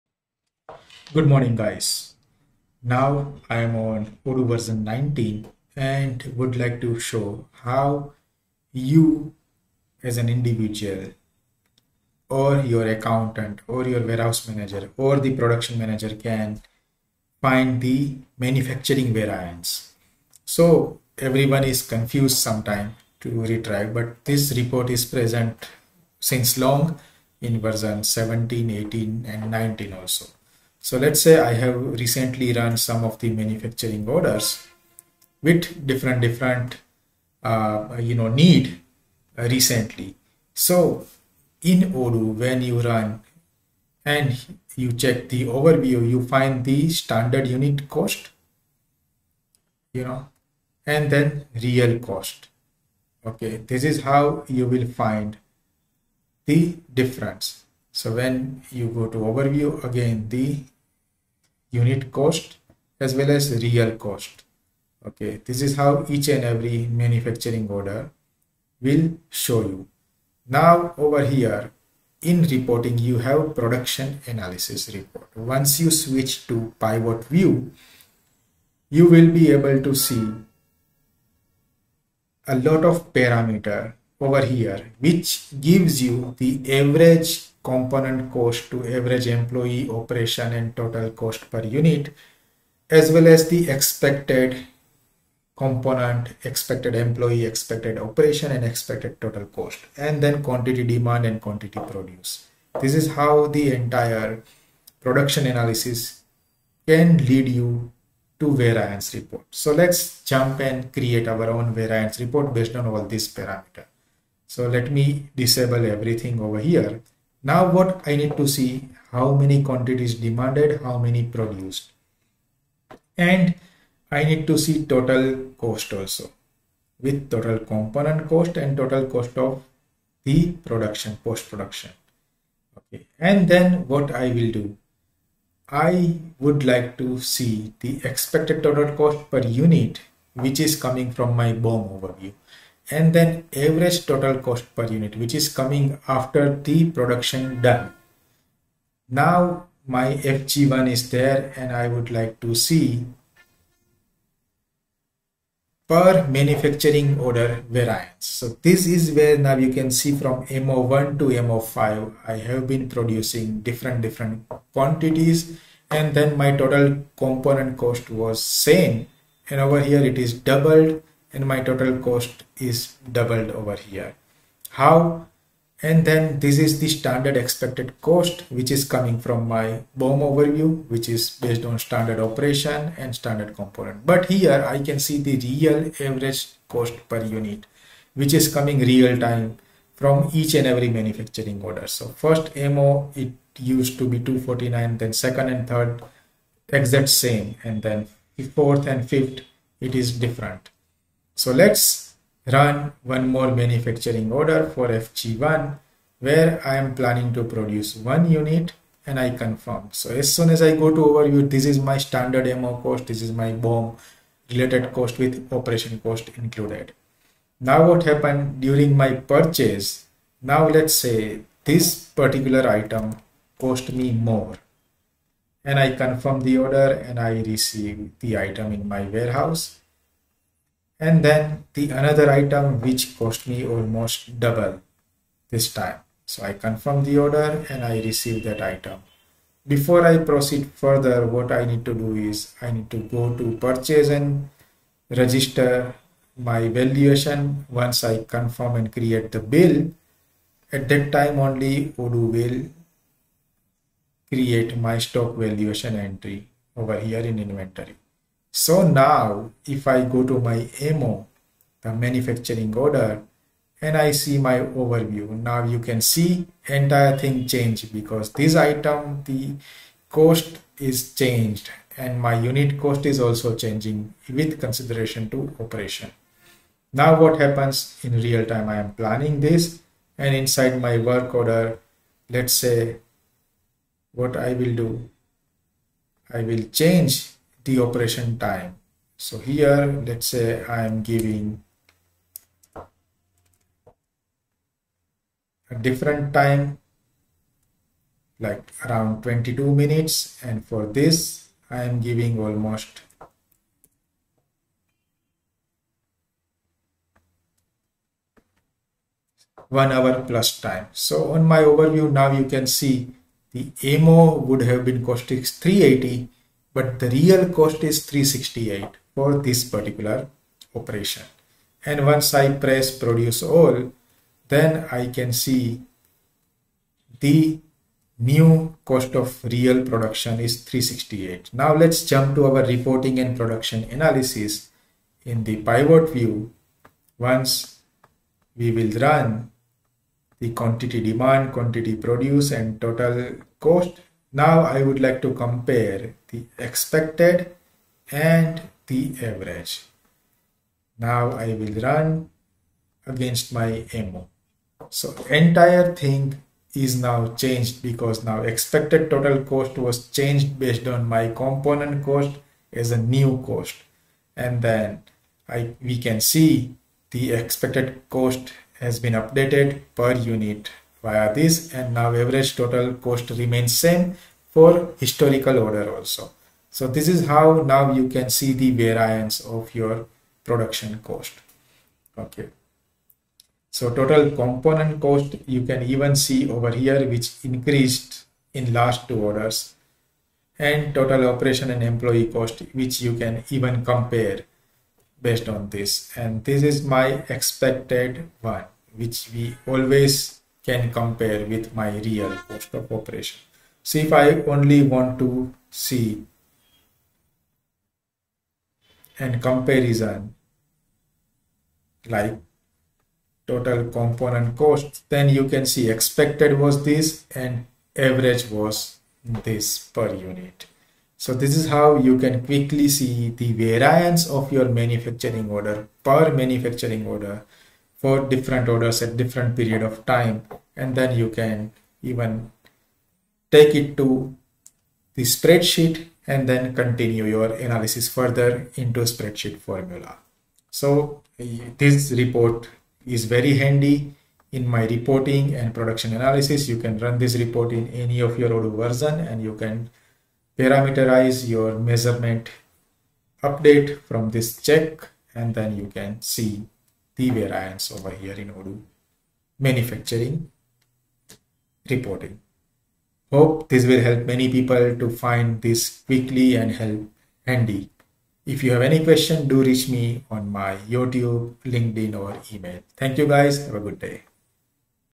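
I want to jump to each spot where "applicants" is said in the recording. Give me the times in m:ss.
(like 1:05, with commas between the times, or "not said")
not said.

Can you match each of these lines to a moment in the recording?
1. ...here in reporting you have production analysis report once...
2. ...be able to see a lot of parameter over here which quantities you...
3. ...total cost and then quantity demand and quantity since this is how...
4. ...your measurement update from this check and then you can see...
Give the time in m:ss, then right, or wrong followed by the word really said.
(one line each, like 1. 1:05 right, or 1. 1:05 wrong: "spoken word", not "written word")
1. 1:11 right
2. 1:19 wrong: "gives", not "quantities"
3. 1:39 wrong: "produce", not "since"
4. 7:31 right.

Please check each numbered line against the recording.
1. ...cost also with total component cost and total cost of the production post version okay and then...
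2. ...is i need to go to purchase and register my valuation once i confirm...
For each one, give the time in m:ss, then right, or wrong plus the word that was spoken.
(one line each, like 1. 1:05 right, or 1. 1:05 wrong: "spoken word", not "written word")
1. 2:05 wrong: "production", not "version"
2. 4:02 right.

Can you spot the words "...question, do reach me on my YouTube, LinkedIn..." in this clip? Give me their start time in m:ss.
7:49.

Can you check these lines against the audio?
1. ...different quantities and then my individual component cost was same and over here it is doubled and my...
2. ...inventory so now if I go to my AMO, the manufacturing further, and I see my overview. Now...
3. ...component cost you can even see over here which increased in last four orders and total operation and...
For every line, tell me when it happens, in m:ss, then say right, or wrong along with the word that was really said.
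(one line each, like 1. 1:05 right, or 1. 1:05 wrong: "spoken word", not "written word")
1. 2:44 wrong: "total", not "individual"
2. 4:17 wrong: "order", not "further"
3. 6:24 wrong: "two", not "four".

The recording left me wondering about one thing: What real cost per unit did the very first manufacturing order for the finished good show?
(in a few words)
249.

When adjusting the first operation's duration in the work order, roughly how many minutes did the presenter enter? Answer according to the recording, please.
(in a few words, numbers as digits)
22.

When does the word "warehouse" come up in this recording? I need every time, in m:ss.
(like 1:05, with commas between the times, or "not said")
0:14, 3:49.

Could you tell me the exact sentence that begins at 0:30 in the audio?
So let's say I have recently run some of the manufacturing orders with different different uh, you know need uh, recently.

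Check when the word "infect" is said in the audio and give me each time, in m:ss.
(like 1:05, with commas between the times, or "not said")
not said.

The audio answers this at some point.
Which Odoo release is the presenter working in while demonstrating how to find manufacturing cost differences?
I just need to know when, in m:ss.
0:04.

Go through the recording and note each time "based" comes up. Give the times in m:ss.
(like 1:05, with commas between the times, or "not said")
1:52, 3:01, 6:00, 6:35.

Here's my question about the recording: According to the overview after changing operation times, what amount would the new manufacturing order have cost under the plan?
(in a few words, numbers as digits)
380.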